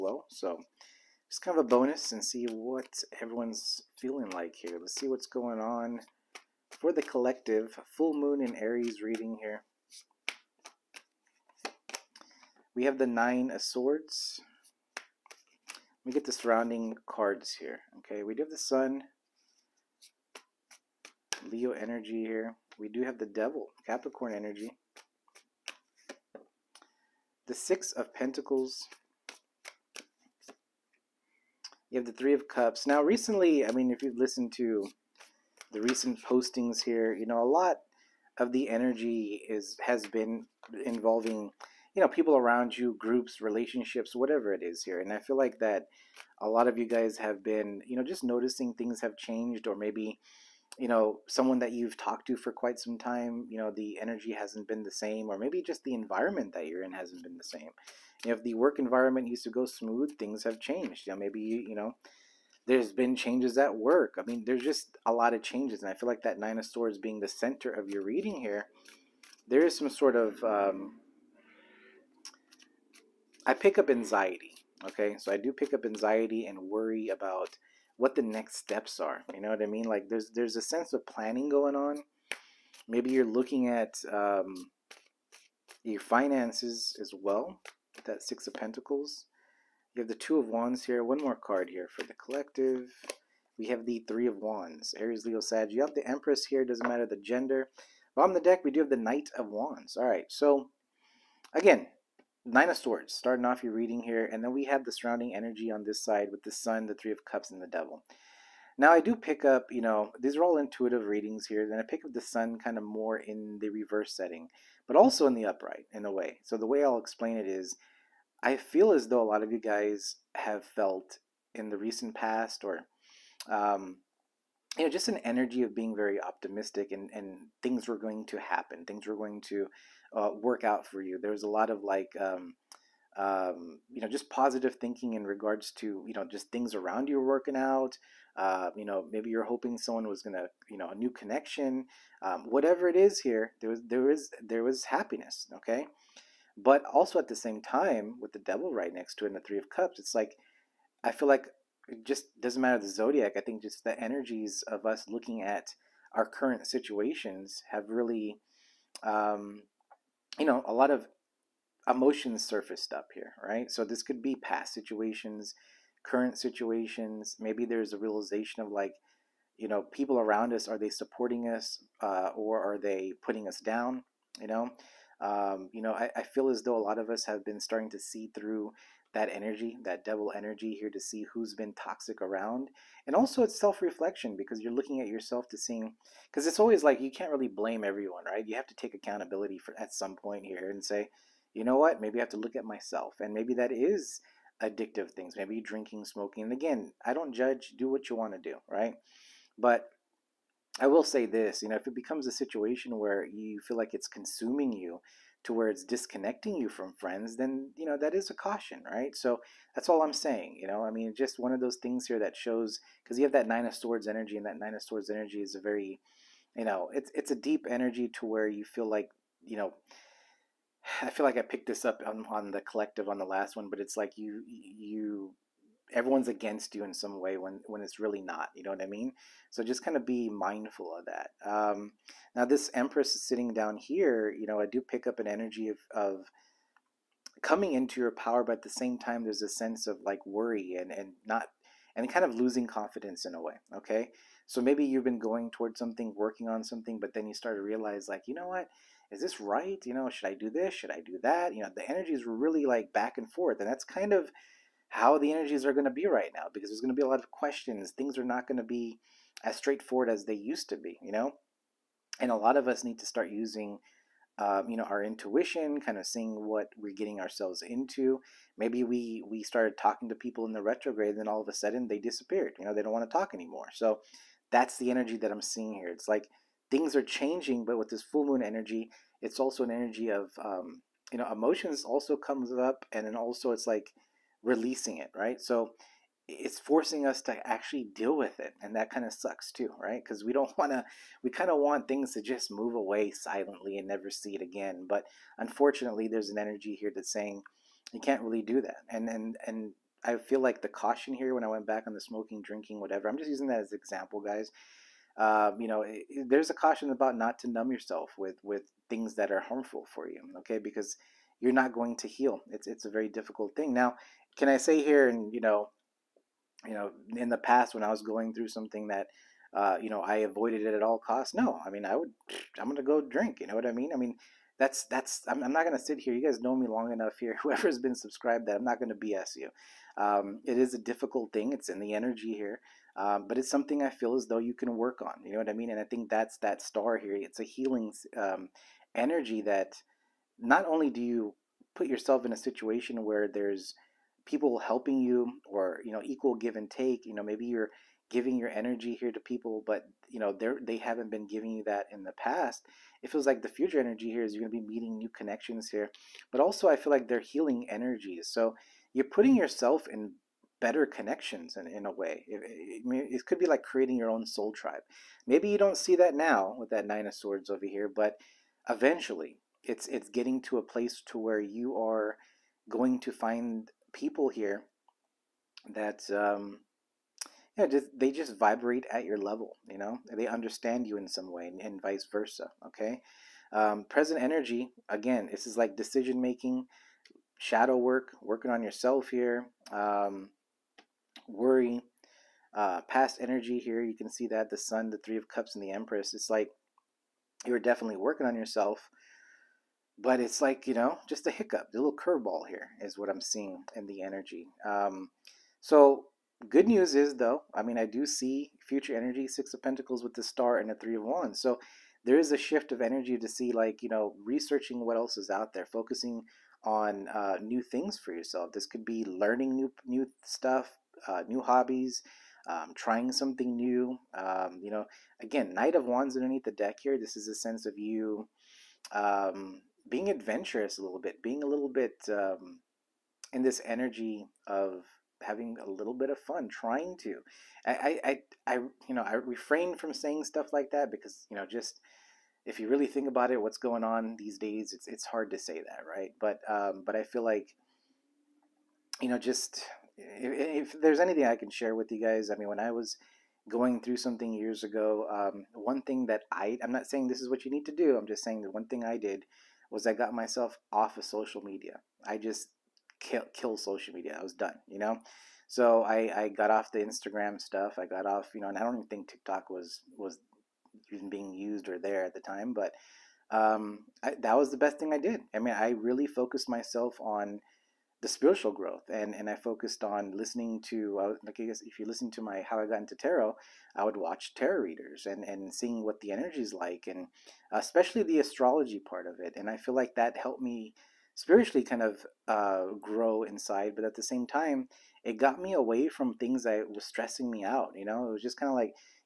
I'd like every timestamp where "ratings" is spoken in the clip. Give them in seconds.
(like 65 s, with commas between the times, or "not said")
not said.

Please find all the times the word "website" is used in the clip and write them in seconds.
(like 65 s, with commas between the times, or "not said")
not said.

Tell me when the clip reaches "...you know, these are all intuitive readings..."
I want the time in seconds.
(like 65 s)
109 s.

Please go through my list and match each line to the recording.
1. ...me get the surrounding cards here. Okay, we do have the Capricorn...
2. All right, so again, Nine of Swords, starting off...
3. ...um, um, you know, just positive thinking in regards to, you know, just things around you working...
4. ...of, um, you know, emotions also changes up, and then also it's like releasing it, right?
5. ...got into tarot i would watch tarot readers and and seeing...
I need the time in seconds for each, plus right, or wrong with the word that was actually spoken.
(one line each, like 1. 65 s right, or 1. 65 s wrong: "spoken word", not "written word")
1. 16 s wrong: "Sun", not "Capricorn"
2. 99 s right
3. 132 s right
4. 280 s wrong: "comes", not "changes"
5. 482 s right.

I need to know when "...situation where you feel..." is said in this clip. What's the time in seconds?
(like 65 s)
202 s.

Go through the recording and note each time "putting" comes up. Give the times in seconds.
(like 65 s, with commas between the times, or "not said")
173 s, 359 s.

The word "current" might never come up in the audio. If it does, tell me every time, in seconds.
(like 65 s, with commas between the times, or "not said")
156 s, 166 s.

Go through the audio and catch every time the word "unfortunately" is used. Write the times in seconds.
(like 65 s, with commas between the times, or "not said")
295 s.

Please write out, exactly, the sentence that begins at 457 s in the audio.
I'm just saying that one thing I did was I got myself off of social media.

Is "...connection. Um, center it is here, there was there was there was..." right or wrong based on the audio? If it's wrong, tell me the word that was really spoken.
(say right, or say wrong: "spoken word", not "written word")
wrong: "whatever", not "center".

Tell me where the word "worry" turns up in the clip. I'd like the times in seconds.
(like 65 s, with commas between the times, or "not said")
76 s, 240 s, 391 s.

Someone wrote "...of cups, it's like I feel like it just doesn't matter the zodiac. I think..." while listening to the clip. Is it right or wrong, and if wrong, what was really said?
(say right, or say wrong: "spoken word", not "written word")
right.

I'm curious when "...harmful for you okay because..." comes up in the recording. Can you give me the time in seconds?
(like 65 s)
309 s.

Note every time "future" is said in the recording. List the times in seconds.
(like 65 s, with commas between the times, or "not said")
353 s, 408 s.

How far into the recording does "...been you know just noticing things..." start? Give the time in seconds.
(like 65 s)
47 s.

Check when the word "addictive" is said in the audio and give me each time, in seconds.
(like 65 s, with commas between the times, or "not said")
194 s.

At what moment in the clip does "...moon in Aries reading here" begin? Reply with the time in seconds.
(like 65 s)
8 s.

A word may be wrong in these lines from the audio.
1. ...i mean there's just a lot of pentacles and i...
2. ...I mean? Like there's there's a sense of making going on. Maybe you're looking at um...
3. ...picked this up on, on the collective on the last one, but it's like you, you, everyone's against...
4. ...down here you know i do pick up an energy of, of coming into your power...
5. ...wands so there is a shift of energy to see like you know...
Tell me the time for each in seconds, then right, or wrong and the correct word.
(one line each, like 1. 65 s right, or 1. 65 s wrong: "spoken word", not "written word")
1. 64 s wrong: "changes", not "pentacles"
2. 79 s wrong: "planning", not "making"
3. 221 s right
4. 233 s right
5. 411 s right.